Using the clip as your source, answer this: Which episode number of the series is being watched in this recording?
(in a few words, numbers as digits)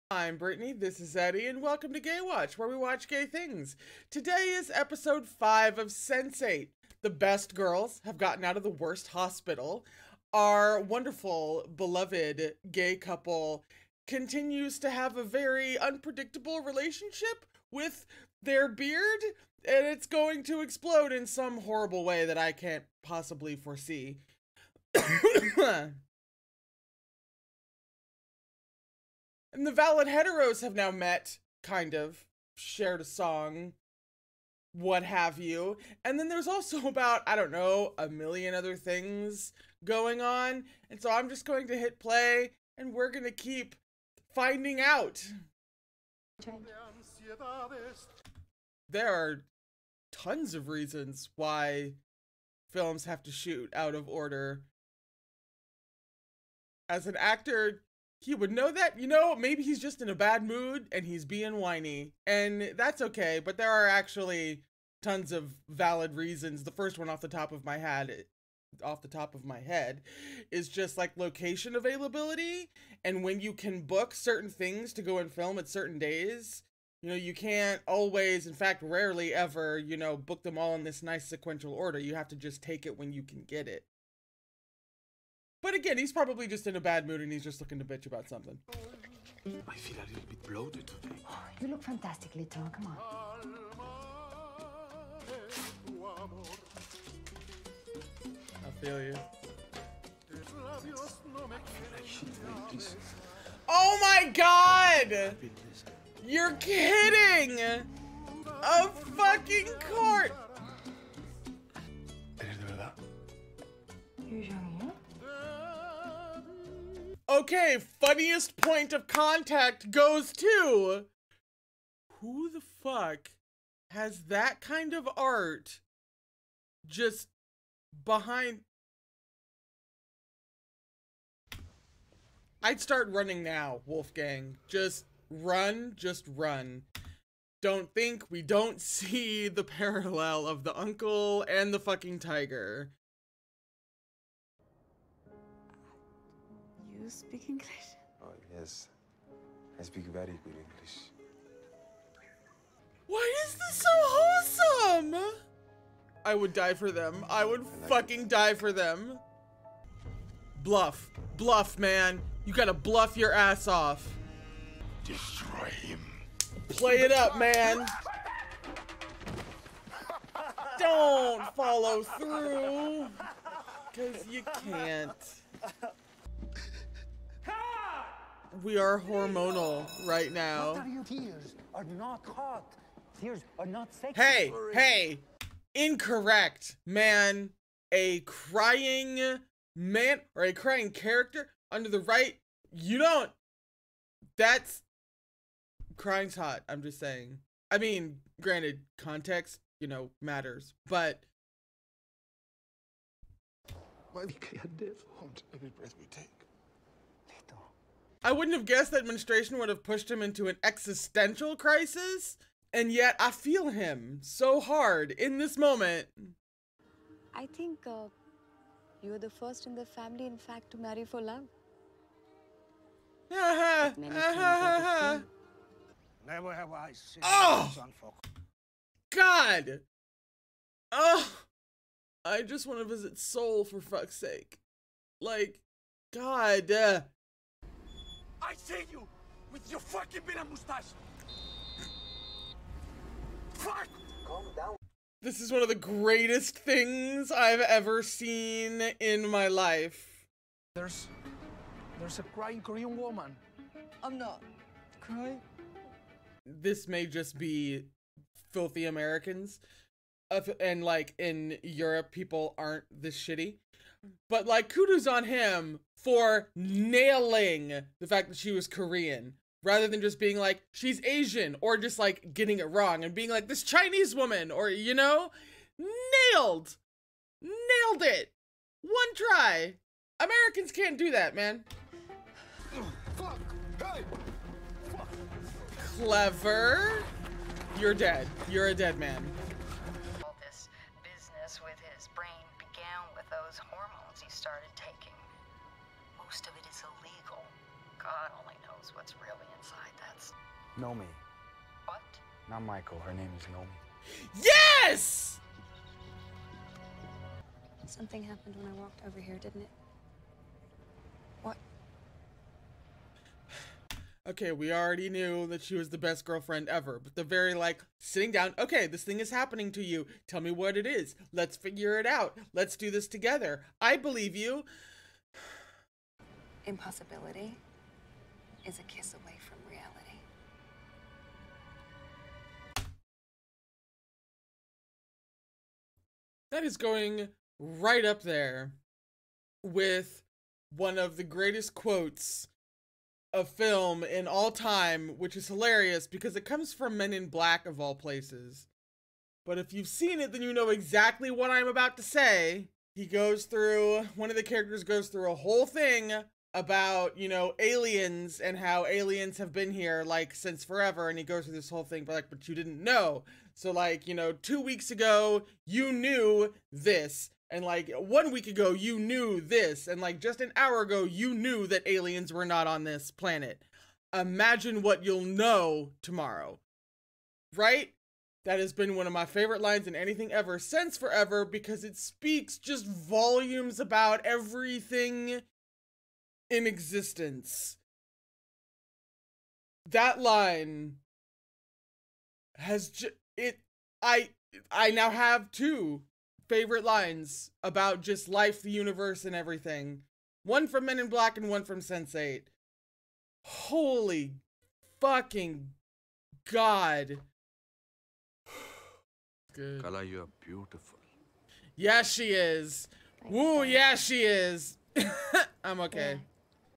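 5.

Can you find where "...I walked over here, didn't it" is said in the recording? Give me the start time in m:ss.
5:08.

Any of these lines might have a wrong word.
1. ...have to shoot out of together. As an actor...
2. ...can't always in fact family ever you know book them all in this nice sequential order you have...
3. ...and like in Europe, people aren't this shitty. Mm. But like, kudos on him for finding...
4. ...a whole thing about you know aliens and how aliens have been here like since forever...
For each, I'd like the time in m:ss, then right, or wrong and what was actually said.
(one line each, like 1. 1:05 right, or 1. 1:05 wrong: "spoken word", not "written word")
1. 0:53 wrong: "order", not "together"
2. 1:17 wrong: "rarely", not "family"
3. 4:20 wrong: "nailing", not "finding"
4. 5:55 right.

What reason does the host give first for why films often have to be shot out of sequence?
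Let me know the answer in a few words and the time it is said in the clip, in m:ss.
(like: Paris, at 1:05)
Location availability, at 1:11.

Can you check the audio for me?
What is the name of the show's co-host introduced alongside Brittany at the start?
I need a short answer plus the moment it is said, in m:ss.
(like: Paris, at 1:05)
Eddie, at 0:01.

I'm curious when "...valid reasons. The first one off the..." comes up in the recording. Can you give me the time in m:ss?
1:05.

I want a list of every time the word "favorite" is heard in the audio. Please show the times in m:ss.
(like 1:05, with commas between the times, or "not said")
6:19, 6:36.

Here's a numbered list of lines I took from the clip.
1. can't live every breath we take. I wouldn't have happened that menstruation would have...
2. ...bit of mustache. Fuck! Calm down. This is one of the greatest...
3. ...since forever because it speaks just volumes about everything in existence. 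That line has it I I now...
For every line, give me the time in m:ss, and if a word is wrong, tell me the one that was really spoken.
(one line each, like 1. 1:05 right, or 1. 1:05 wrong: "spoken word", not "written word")
1. 3:24 wrong: "guessed", not "happened"
2. 4:00 right
3. 6:20 right.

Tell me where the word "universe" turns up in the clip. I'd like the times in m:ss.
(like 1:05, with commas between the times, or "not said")
6:38.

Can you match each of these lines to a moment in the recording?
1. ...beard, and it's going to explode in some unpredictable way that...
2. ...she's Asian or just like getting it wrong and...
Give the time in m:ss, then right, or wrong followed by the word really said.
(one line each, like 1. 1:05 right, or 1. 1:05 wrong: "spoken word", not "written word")
1. 0:18 wrong: "horrible", not "unpredictable"
2. 4:30 right.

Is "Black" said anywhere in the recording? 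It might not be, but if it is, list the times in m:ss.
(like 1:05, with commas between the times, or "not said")
5:47, 6:41.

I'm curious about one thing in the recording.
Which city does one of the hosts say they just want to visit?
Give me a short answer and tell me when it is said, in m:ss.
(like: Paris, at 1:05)
Seoul, at 3:53.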